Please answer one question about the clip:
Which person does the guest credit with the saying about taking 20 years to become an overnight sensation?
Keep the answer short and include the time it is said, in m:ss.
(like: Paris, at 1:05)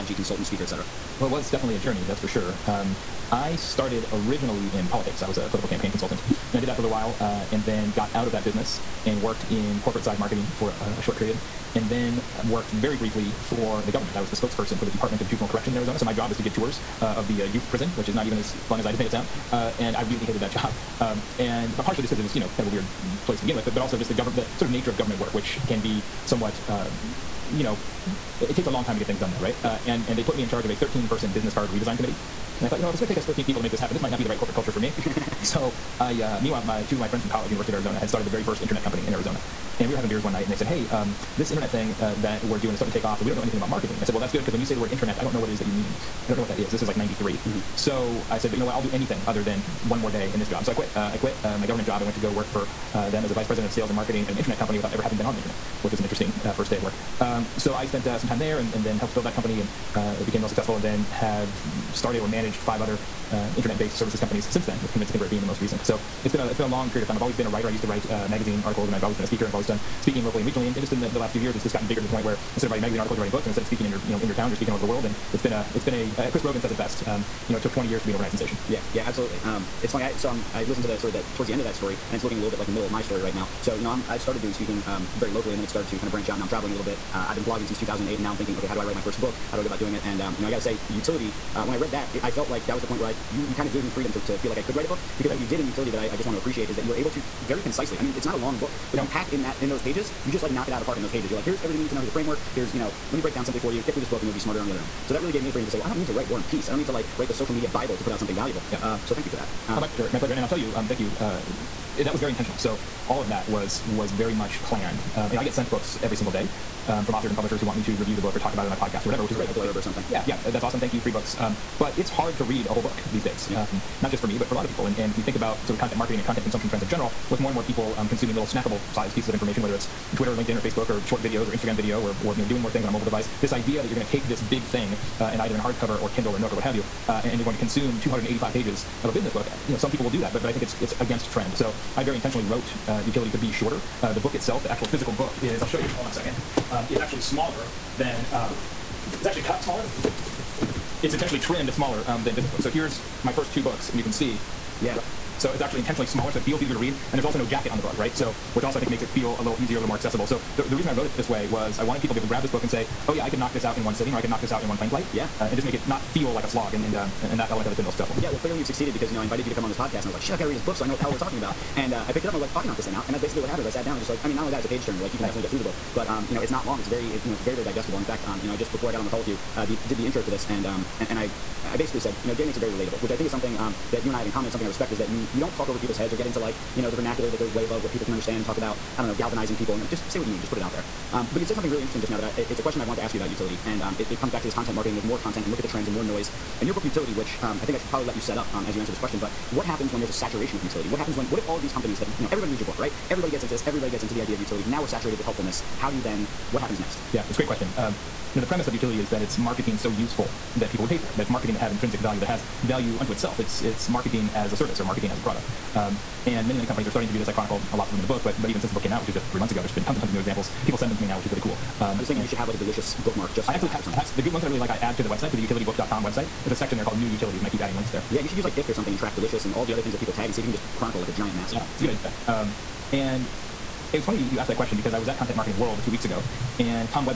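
Chris Brogan, at 1:16.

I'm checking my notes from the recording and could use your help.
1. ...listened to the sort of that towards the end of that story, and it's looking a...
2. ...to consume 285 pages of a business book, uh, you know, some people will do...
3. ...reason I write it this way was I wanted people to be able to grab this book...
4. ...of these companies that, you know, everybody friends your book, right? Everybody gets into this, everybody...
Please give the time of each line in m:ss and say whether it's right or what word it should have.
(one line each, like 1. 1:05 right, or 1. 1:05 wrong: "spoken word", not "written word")
1. 1:20 right
2. 2:17 right
3. 2:40 wrong: "wrote", not "write"
4. 3:21 wrong: "reads", not "friends".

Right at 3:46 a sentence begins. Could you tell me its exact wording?
There's a section there called New Utilities, and I keep adding links there.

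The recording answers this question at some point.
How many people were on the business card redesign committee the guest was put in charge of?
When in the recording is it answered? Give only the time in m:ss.
0:30.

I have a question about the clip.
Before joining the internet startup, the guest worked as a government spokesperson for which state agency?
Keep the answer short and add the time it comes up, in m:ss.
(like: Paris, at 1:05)
Department of Juvenile Corrections, at 0:14.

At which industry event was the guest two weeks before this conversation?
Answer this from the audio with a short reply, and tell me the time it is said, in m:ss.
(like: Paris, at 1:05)
Content Marketing World, at 3:55.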